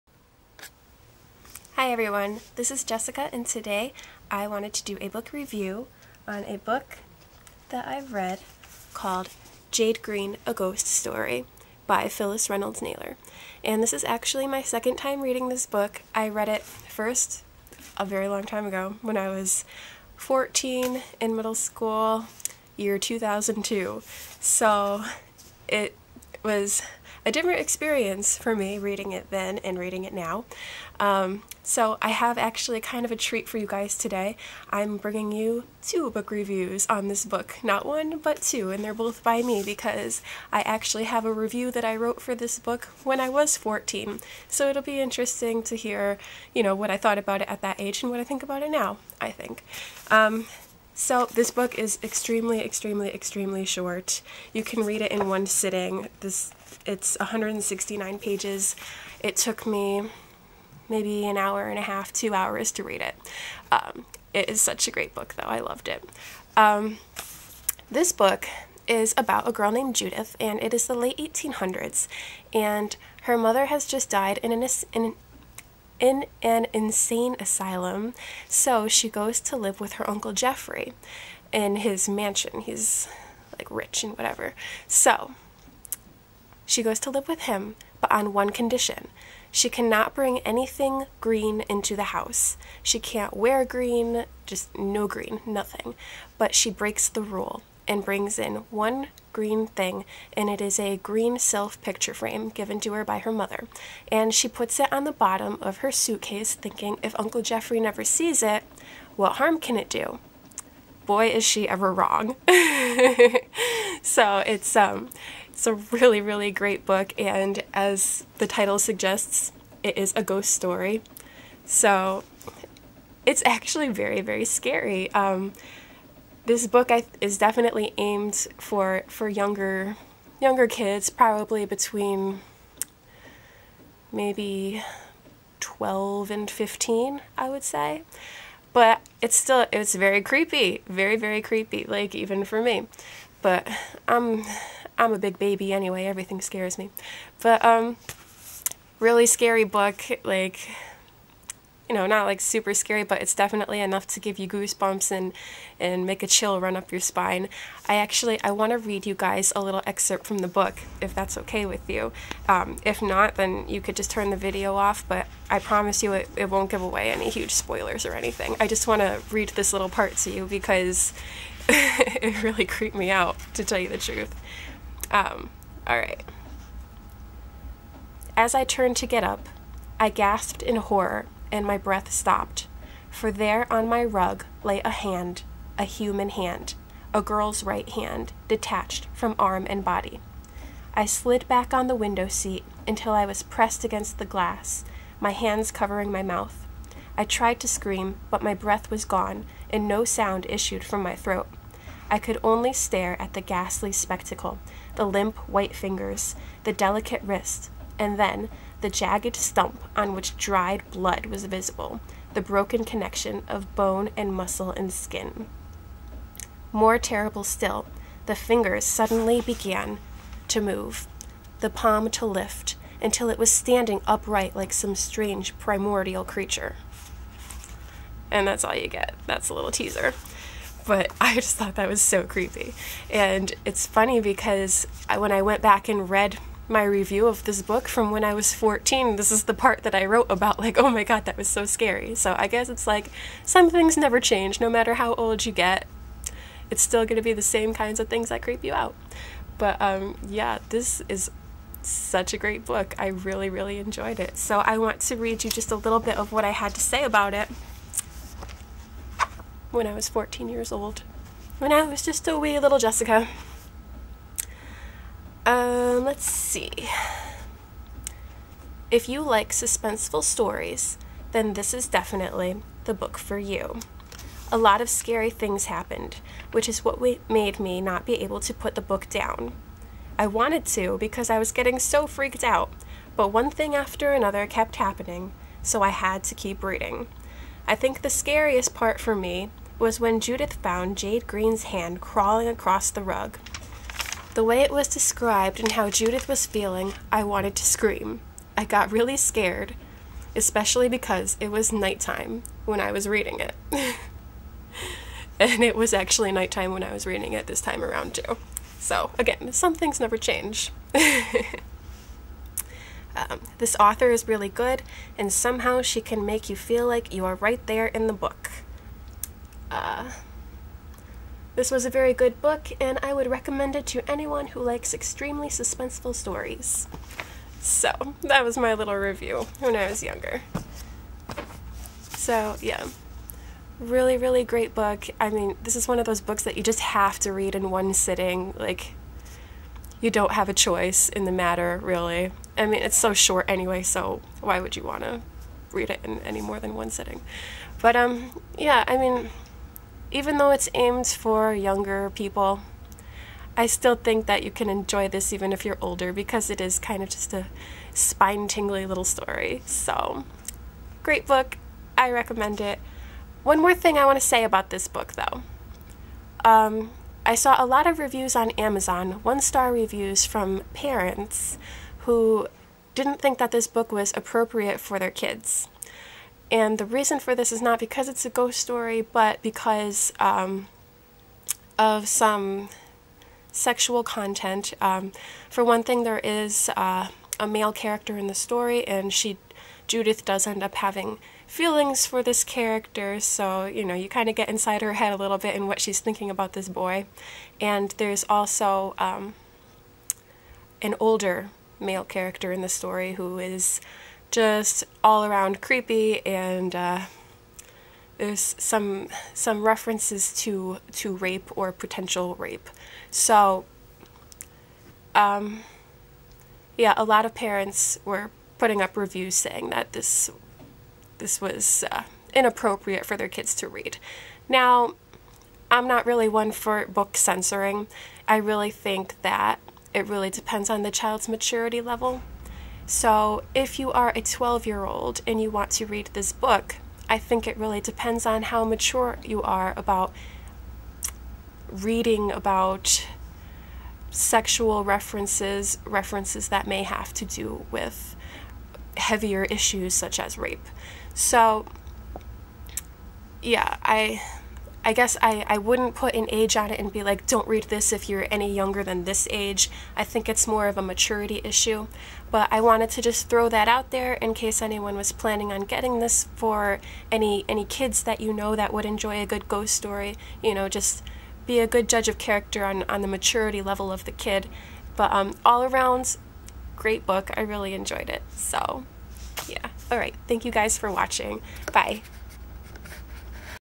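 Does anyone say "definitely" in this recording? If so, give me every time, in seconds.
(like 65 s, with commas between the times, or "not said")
127 s, 153 s, 271 s.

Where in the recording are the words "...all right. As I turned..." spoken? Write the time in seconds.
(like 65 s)
175 s.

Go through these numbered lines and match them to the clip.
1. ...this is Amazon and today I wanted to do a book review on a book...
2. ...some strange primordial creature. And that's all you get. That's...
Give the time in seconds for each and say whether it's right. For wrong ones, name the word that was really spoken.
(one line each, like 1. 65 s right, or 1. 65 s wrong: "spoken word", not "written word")
1. 2 s wrong: "Jessica", not "Amazon"
2. 224 s right.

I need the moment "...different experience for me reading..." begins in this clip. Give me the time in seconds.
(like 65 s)
27 s.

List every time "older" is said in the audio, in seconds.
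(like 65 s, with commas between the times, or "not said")
355 s, 400 s.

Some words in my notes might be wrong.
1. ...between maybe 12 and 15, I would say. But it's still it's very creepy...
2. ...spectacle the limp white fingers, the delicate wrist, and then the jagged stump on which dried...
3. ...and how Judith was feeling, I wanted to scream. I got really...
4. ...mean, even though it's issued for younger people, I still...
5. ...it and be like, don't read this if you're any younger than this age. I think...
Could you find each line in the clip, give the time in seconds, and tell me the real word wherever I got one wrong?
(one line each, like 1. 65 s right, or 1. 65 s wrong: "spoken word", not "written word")
1. 131 s right
2. 203 s right
3. 295 s right
4. 348 s wrong: "aimed", not "issued"
5. 456 s right.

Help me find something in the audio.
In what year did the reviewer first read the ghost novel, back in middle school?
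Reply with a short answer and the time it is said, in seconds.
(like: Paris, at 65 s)
2002, at 22 s.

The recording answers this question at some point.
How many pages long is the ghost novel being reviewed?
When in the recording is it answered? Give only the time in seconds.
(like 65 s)
57 s.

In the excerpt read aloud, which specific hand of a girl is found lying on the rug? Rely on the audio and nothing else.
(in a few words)
right hand.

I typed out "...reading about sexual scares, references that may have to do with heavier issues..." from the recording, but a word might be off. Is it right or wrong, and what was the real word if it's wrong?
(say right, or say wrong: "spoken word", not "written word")
wrong: "references", not "scares".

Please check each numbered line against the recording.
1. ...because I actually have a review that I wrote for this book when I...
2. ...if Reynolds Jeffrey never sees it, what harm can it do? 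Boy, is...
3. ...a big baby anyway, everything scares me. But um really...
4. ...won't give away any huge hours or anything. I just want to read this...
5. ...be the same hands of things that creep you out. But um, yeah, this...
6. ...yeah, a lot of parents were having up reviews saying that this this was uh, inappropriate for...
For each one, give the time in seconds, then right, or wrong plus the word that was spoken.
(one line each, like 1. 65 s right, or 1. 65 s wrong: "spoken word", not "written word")
1. 39 s right
2. 107 s wrong: "Uncle", not "Reynolds"
3. 145 s right
4. 166 s wrong: "spoilers", not "hours"
5. 247 s wrong: "kinds", not "hands"
6. 416 s wrong: "putting", not "having".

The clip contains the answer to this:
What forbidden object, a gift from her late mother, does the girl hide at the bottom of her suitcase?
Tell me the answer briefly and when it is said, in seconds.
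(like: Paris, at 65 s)
green silk picture frame, at 100 s.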